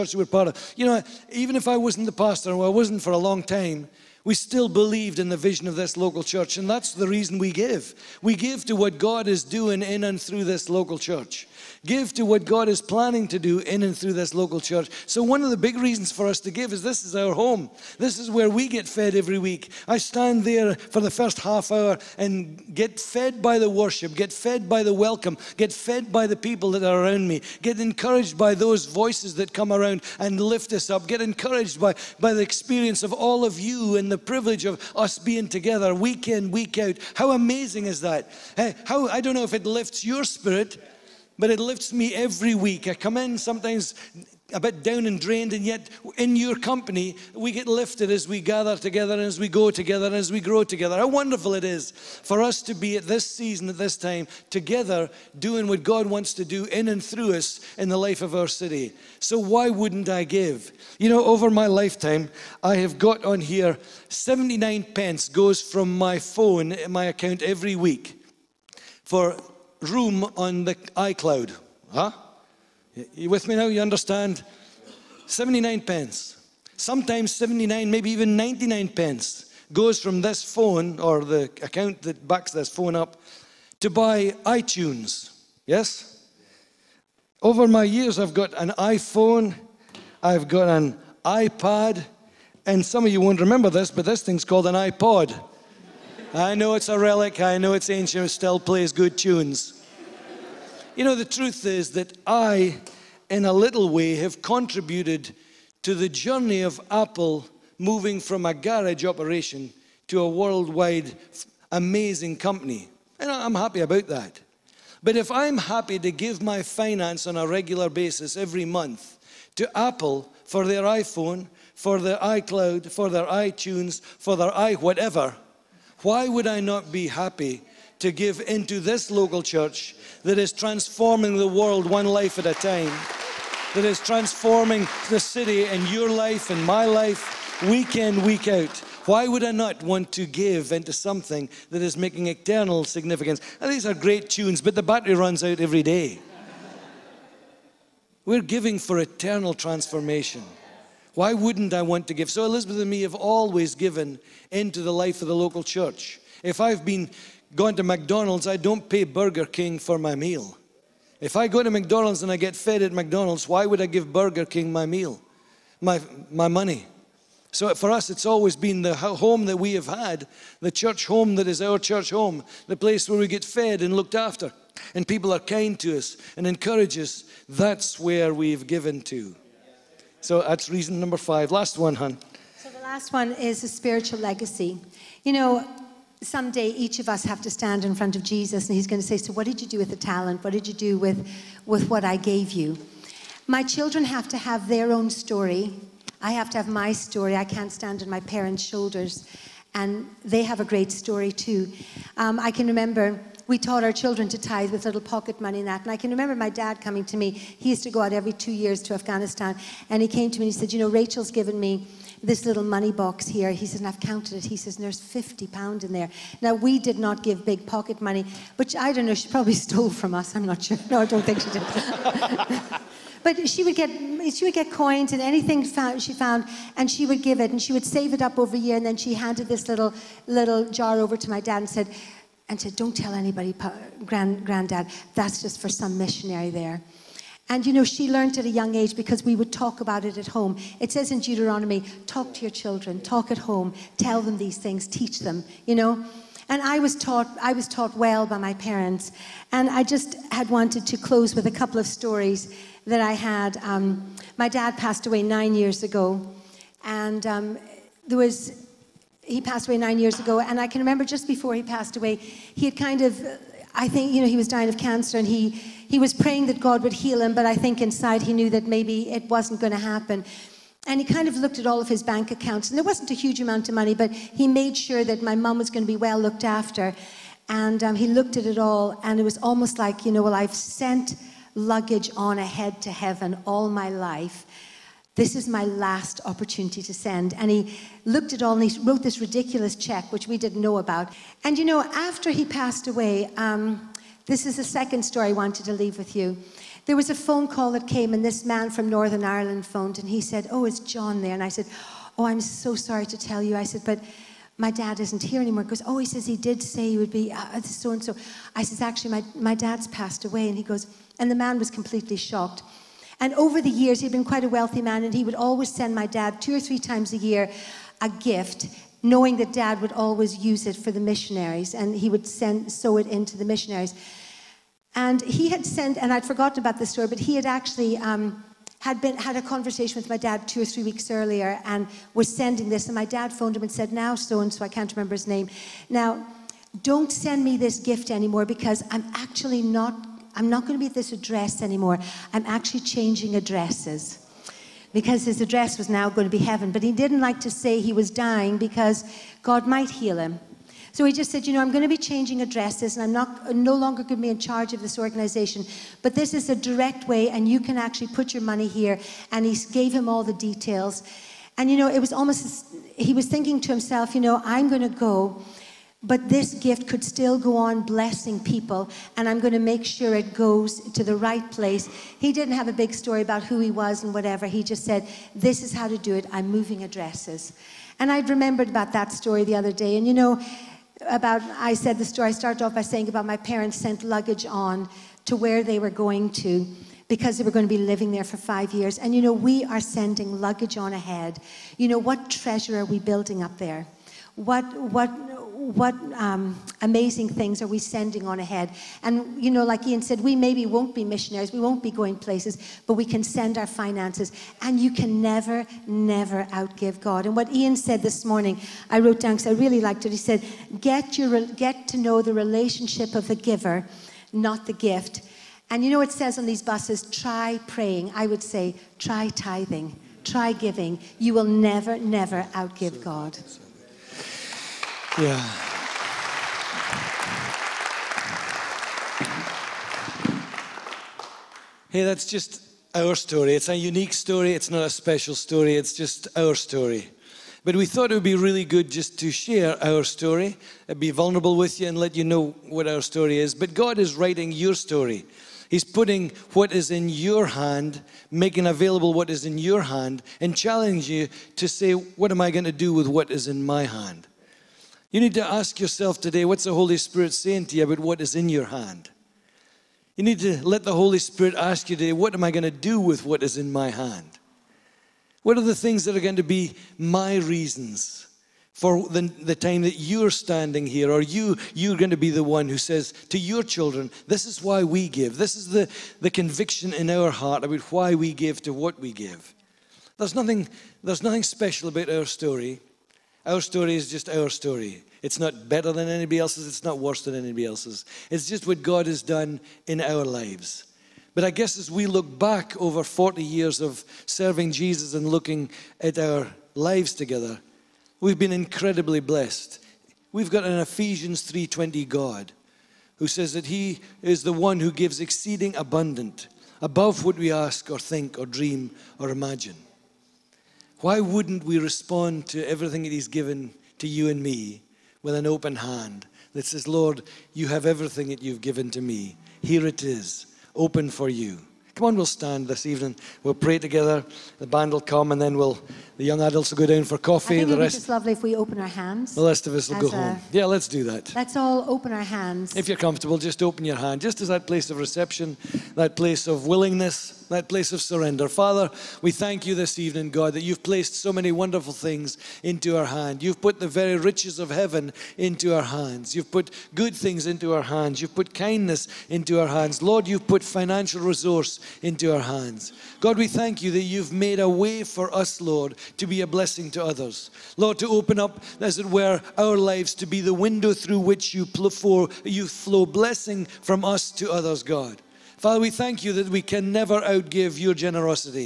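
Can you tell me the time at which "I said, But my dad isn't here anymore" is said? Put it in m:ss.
5:03.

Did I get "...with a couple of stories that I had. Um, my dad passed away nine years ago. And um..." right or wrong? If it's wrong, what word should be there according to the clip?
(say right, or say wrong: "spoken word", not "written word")
right.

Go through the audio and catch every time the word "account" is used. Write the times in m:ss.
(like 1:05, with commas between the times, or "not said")
1:07, 1:21, 4:32.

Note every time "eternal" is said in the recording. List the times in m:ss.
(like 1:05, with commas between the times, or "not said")
2:22, 2:28.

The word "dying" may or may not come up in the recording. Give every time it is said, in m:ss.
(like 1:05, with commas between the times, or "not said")
4:24, 5:48.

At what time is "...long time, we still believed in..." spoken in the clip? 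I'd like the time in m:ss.
0:03.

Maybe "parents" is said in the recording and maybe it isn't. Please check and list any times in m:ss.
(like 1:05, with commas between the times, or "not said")
3:18, 4:08, 6:23.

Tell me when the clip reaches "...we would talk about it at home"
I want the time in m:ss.
3:59.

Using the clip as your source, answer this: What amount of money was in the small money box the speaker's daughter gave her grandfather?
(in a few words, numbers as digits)
50 pound.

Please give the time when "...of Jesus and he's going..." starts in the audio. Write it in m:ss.
3:08.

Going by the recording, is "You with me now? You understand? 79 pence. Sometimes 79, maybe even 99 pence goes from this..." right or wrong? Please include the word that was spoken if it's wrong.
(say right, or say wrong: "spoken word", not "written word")
right.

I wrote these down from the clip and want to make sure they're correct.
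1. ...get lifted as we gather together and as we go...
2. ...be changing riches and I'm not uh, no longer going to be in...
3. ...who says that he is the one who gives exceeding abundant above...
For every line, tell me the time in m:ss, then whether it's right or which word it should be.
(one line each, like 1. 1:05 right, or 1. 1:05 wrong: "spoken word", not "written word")
1. 0:47 right
2. 5:51 wrong: "addresses", not "riches"
3. 8:23 right.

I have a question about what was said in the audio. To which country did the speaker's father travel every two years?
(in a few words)
Afghanistan.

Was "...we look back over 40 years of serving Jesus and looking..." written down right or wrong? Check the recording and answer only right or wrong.
right.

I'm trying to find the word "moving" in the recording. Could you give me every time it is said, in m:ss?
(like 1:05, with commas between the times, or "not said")
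1:47, 6:16.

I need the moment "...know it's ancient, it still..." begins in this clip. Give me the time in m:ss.
1:37.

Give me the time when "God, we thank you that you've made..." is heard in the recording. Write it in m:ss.
9:13.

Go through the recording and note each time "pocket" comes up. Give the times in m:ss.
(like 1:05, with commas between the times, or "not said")
3:24, 3:37.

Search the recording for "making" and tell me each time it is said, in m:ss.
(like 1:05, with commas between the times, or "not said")
2:21, 7:28.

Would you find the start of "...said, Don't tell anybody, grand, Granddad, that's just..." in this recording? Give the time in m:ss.
3:52.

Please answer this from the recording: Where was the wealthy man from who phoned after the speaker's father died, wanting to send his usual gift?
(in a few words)
Northern Ireland.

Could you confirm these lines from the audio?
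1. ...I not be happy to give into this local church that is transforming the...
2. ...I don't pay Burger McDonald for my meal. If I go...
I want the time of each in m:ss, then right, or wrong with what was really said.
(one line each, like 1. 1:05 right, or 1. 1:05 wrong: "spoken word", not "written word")
1. 2:06 right
2. 2:38 wrong: "King", not "McDonald".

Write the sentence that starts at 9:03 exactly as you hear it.
You've put the very riches of heaven into our hands.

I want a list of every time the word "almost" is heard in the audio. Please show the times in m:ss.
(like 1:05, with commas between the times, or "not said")
4:39, 6:02.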